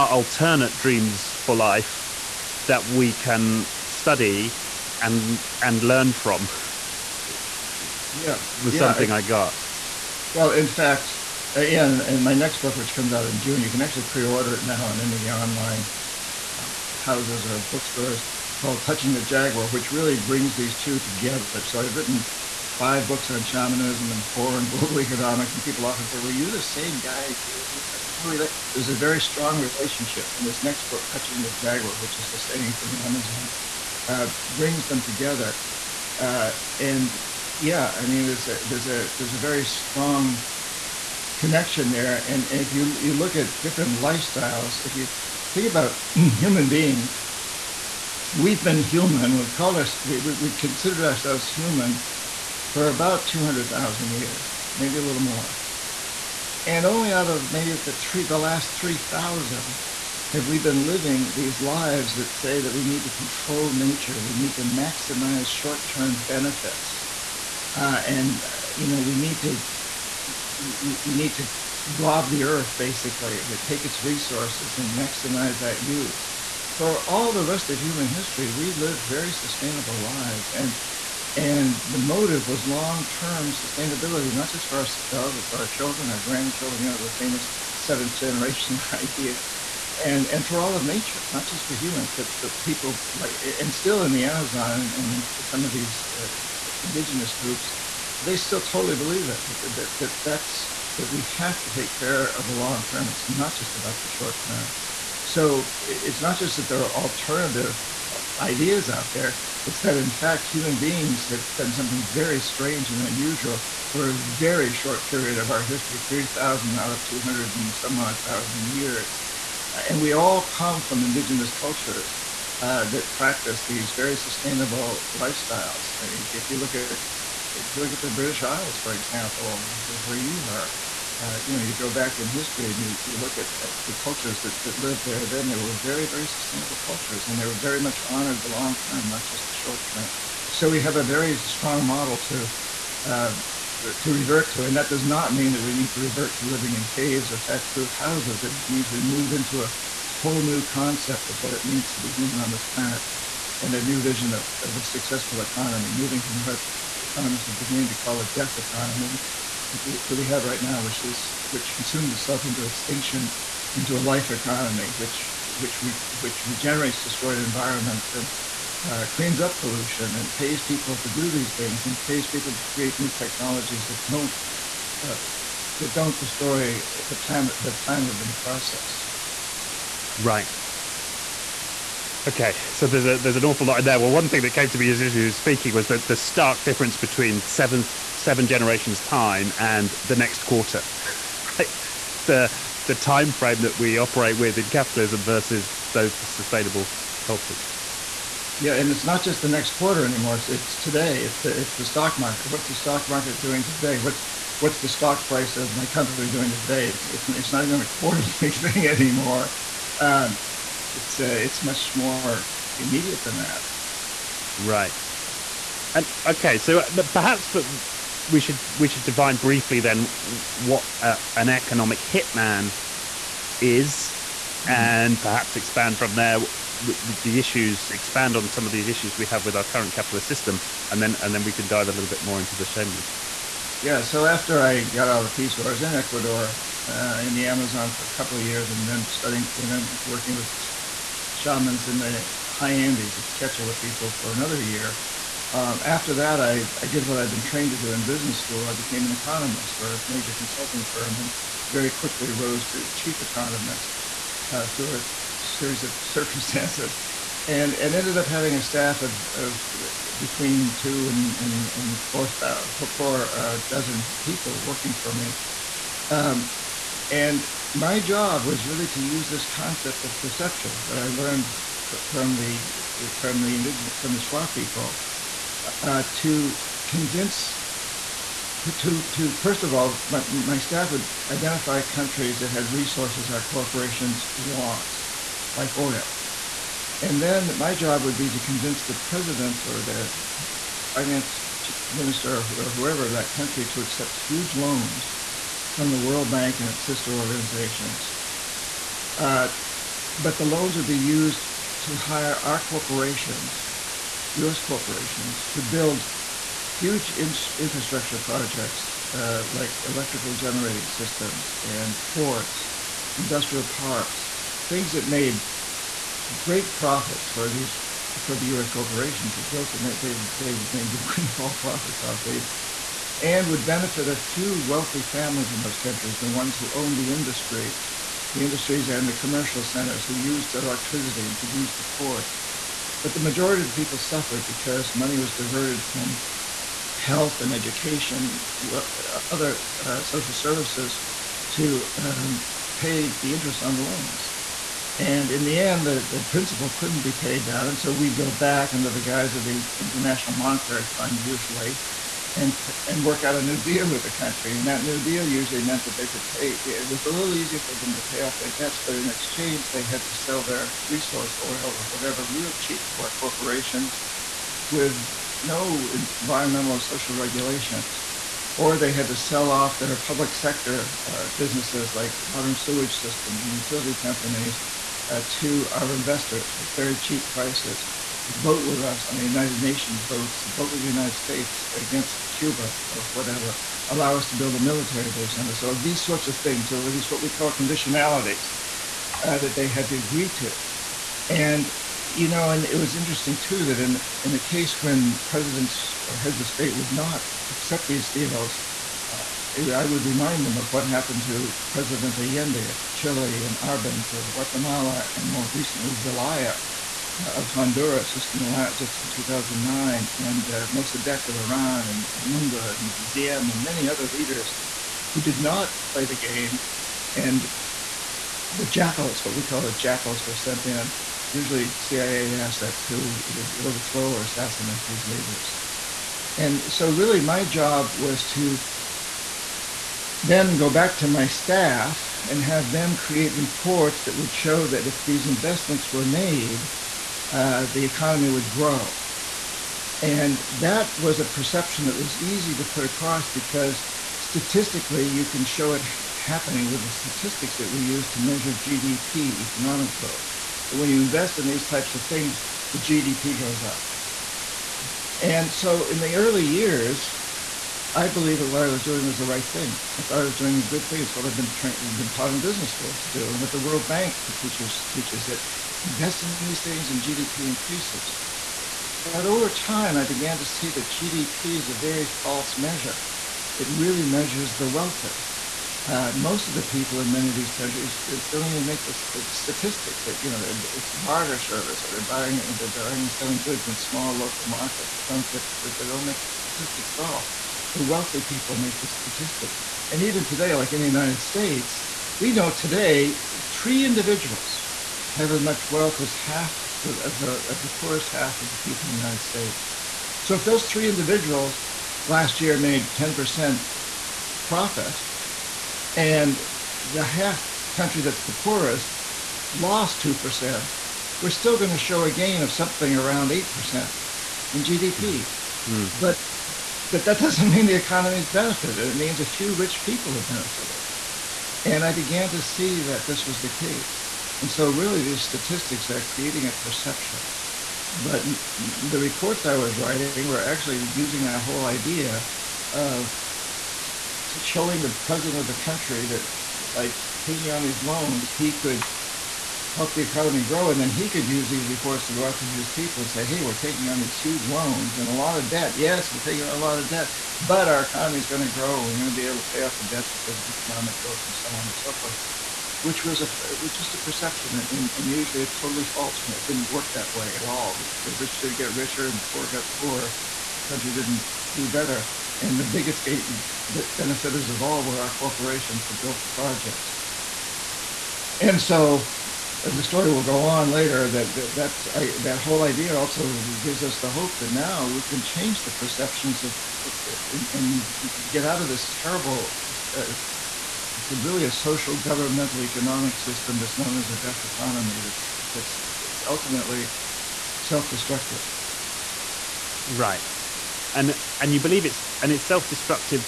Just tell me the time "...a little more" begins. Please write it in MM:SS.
00:54.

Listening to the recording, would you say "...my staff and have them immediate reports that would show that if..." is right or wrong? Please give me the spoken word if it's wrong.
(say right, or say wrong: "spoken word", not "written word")
wrong: "create", not "immediate".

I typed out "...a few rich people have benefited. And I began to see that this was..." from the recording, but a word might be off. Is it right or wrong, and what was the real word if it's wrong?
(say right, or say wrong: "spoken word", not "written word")
right.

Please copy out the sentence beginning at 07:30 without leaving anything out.
That when you invest in these types of things, the GDP goes up.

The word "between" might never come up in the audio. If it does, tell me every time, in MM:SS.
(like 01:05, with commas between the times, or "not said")
03:06, 04:20.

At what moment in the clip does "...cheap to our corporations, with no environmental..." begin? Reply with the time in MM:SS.
06:02.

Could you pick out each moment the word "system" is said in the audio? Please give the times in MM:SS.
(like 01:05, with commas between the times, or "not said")
03:50, 05:10, 06:12, 09:43.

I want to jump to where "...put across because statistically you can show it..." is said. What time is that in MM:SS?
07:22.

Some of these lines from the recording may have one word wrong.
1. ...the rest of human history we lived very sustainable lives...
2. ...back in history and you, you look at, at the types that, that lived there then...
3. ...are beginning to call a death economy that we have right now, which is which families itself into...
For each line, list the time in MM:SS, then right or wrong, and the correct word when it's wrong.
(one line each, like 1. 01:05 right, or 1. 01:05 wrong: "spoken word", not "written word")
1. 01:17 right
2. 02:11 wrong: "cultures", not "types"
3. 02:37 wrong: "consumes", not "families".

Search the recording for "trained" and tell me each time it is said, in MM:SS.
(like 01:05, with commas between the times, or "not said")
04:07, 07:41.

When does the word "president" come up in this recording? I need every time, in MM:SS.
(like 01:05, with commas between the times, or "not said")
04:48, 06:35, 06:41, 08:55.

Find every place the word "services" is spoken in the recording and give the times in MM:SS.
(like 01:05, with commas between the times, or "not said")
05:40, 08:01.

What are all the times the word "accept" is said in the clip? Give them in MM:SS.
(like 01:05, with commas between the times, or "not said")
04:53, 06:37.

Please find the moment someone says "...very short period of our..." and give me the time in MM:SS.
01:54.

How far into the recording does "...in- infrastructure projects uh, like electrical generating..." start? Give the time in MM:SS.
05:07.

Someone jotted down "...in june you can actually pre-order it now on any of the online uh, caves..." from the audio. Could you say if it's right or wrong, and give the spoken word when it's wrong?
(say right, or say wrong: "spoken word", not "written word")
wrong: "houses", not "caves".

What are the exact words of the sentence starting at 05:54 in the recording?
And that new deal usually meant that they could pay.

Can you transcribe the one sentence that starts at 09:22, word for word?
And the biggest gate, benefiters of all were our corporations that built the projects.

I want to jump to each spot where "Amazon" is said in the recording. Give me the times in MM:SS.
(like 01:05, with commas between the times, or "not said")
00:32, 01:34, 03:57.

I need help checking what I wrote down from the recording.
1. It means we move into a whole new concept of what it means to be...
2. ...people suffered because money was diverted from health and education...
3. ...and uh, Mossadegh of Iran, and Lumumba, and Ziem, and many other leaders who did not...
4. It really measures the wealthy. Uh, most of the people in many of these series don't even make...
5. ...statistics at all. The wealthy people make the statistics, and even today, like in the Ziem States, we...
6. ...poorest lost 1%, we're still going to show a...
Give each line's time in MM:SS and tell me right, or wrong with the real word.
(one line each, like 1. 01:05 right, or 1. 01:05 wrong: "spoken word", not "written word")
1. 02:28 right
2. 05:33 right
3. 06:50 right
4. 07:53 wrong: "countries", not "series"
5. 08:06 wrong: "United", not "Ziem"
6. 08:28 wrong: "2", not "1".